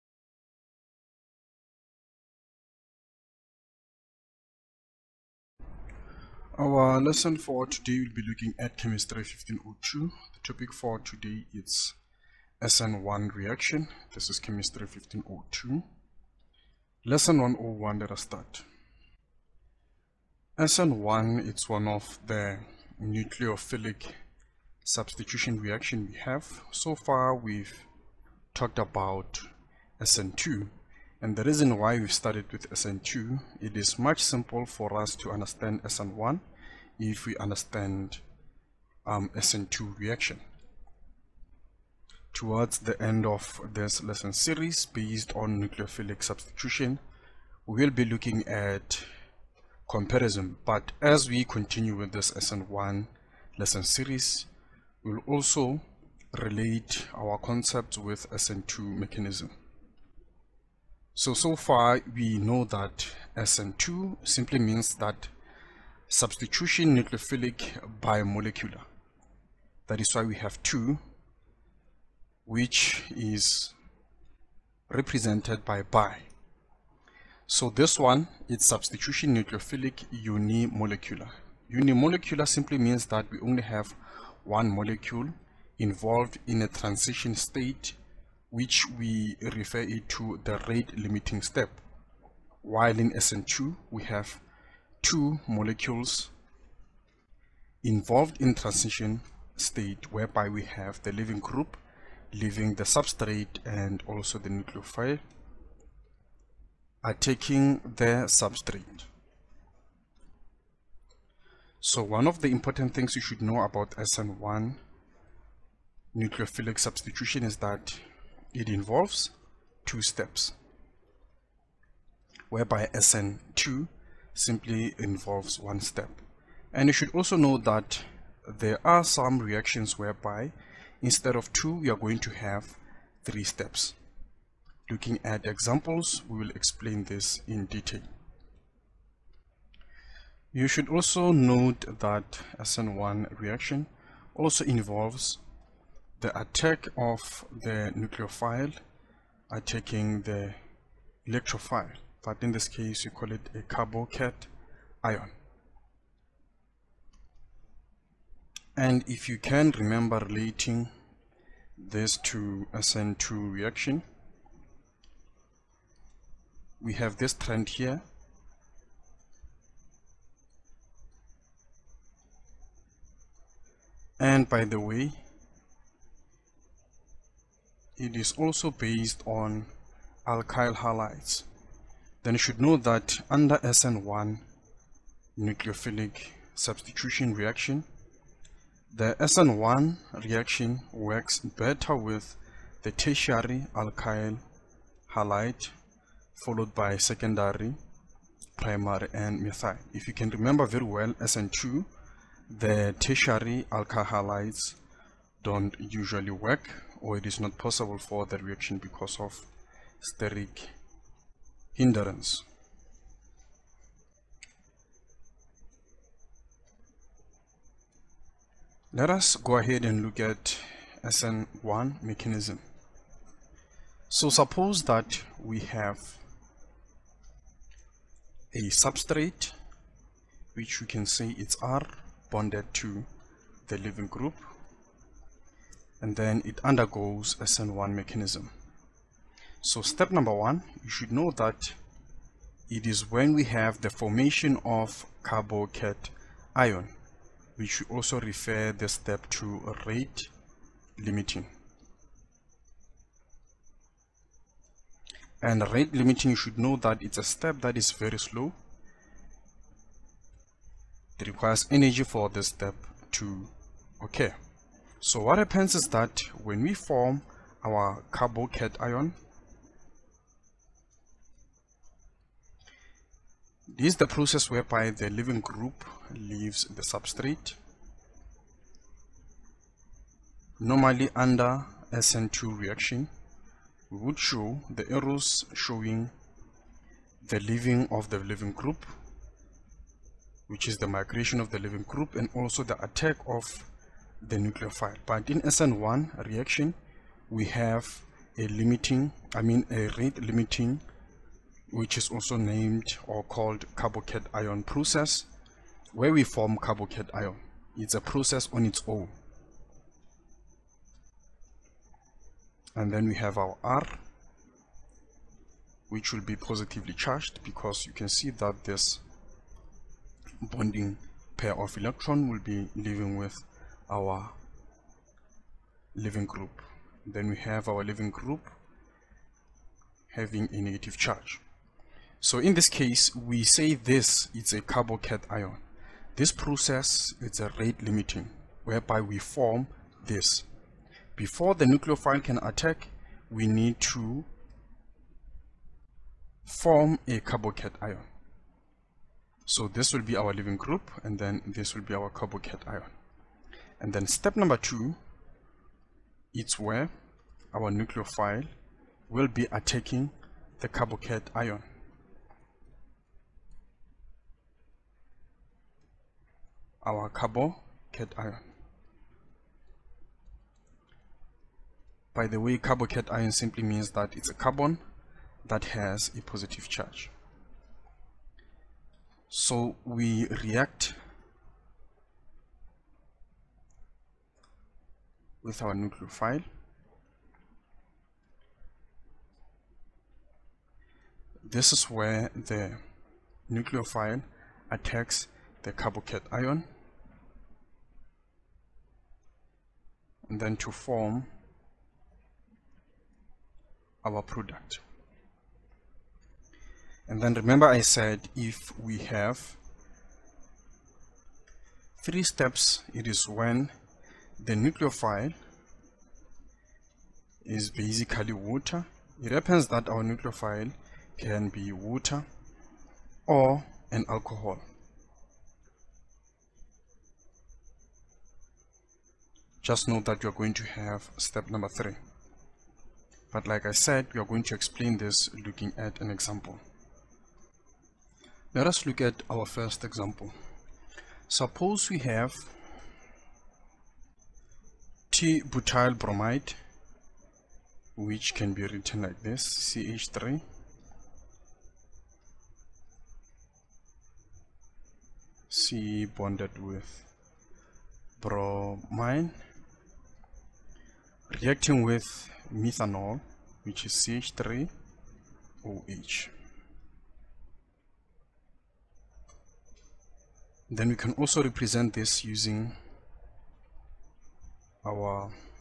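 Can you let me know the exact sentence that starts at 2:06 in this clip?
And you should also know that there are some reactions whereby instead of two, we are going to have three steps.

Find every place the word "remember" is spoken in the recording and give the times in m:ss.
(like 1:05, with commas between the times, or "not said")
2:39, 3:20, 6:47.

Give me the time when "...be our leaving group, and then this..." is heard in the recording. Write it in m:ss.
5:50.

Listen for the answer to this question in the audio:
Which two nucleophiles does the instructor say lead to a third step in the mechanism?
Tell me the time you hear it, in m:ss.
7:01.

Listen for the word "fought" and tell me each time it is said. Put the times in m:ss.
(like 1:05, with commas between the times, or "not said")
not said.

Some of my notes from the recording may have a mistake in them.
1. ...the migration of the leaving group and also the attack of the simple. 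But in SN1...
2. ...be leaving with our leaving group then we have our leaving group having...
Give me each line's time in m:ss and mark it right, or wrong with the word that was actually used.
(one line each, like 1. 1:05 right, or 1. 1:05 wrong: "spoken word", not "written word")
1. 4:50 wrong: "nucleophile", not "simple"
2. 5:22 right.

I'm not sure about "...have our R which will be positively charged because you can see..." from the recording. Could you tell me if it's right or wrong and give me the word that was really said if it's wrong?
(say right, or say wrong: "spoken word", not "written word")
right.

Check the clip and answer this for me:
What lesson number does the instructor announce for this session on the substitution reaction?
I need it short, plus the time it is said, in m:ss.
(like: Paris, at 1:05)
101, at 0:17.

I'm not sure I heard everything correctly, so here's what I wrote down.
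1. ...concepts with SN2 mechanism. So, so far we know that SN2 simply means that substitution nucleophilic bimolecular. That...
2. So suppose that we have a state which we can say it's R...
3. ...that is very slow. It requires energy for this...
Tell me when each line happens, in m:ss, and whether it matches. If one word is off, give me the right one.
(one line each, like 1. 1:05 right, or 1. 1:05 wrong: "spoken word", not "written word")
1. 0:57 right
2. 3:44 wrong: "substrate", not "state"
3. 4:17 right.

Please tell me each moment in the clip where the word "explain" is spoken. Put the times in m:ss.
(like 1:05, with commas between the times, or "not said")
2:16, 7:14.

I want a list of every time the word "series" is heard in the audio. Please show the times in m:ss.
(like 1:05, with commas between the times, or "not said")
0:44, 0:53.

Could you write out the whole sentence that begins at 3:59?
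So step number one, you should know that it is when we have the formation of carbocation ion.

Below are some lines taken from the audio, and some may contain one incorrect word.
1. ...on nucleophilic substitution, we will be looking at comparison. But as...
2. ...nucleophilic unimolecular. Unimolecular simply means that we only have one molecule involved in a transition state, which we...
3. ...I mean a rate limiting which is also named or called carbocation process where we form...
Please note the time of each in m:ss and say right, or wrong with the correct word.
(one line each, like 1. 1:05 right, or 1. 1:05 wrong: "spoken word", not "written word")
1. 0:45 right
2. 1:19 right
3. 4:59 right.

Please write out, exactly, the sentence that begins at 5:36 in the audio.
This process is a rate limiting, whereby we form this.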